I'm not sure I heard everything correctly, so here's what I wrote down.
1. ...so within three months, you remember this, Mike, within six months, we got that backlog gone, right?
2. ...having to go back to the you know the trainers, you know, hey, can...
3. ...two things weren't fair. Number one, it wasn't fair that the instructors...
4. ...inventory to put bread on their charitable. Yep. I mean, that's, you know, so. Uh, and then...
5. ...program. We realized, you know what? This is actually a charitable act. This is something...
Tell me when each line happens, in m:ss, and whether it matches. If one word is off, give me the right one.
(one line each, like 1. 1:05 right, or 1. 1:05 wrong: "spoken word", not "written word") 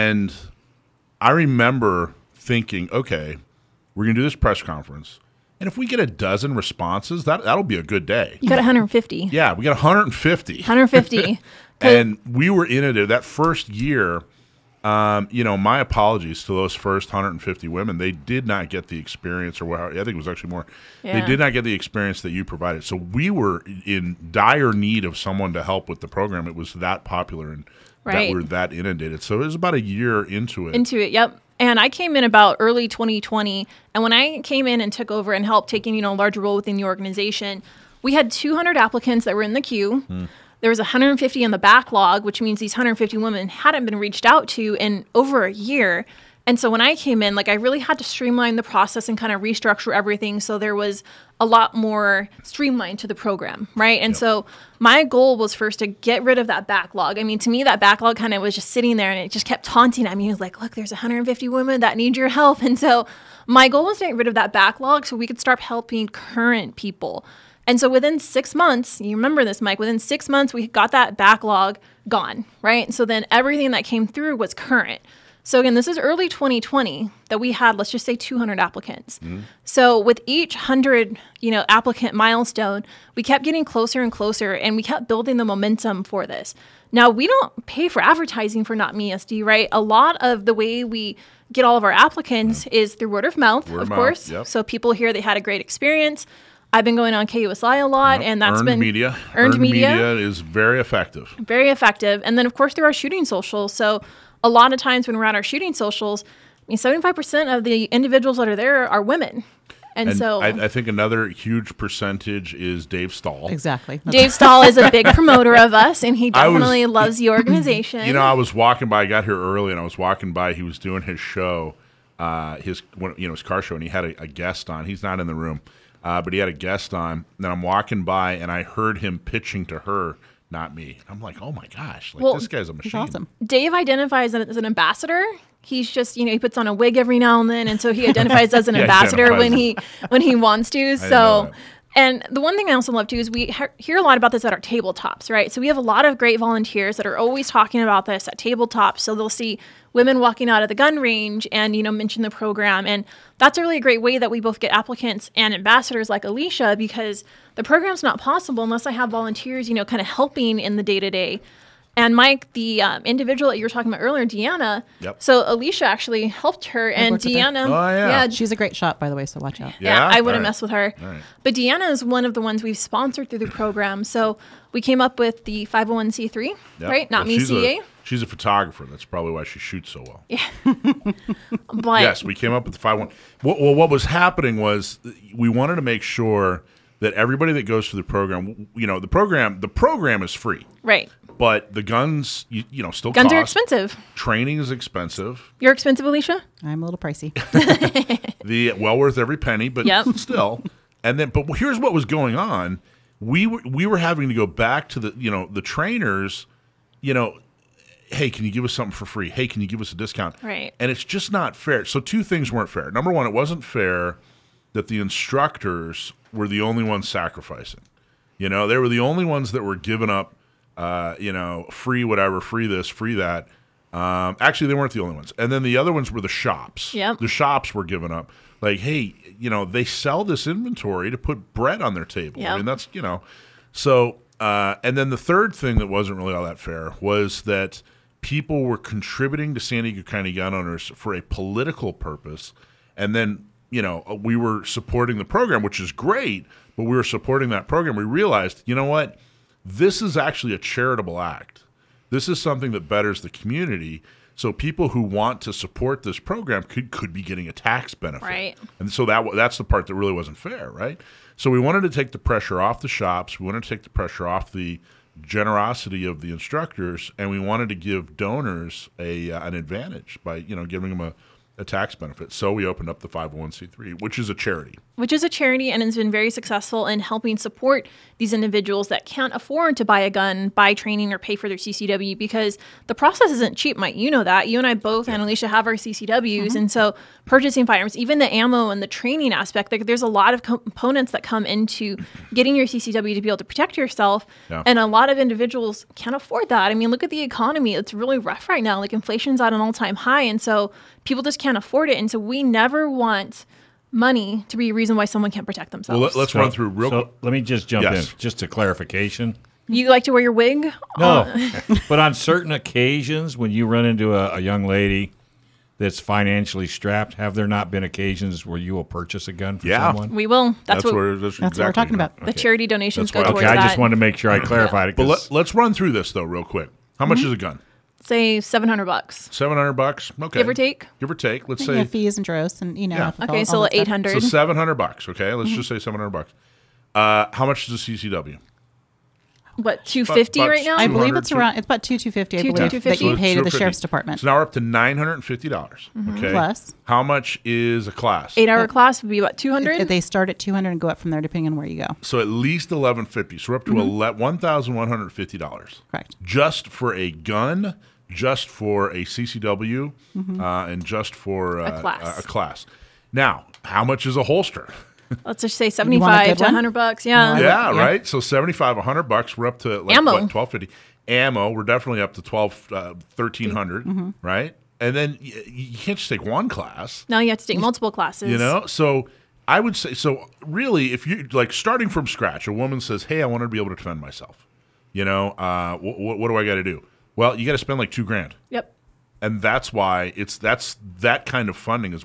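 1. 1:07 wrong: "six", not "three"
2. 3:23 right
3. 3:31 right
4. 3:50 wrong: "table", not "charitable"
5. 4:07 right.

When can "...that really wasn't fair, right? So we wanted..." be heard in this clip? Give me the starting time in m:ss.
4:19.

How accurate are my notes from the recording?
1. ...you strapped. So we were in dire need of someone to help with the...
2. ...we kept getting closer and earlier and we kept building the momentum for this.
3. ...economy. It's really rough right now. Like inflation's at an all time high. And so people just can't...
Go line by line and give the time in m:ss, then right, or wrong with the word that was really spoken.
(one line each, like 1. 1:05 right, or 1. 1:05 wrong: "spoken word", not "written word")
1. 0:22 wrong: "provided", not "strapped"
2. 1:23 wrong: "closer", not "earlier"
3. 4:57 right.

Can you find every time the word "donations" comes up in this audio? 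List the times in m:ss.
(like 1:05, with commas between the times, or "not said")
5:22.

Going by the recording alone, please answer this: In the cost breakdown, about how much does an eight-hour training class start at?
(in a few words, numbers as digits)
$200.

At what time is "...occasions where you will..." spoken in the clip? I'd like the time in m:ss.
5:17.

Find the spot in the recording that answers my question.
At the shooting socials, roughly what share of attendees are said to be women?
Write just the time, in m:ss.
1:46.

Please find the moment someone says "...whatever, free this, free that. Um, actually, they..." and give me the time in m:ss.
3:42.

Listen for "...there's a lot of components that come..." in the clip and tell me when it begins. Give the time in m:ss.
4:49.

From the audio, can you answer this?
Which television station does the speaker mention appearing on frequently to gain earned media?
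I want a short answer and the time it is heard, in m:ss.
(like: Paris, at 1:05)
KUSI, at 1:37.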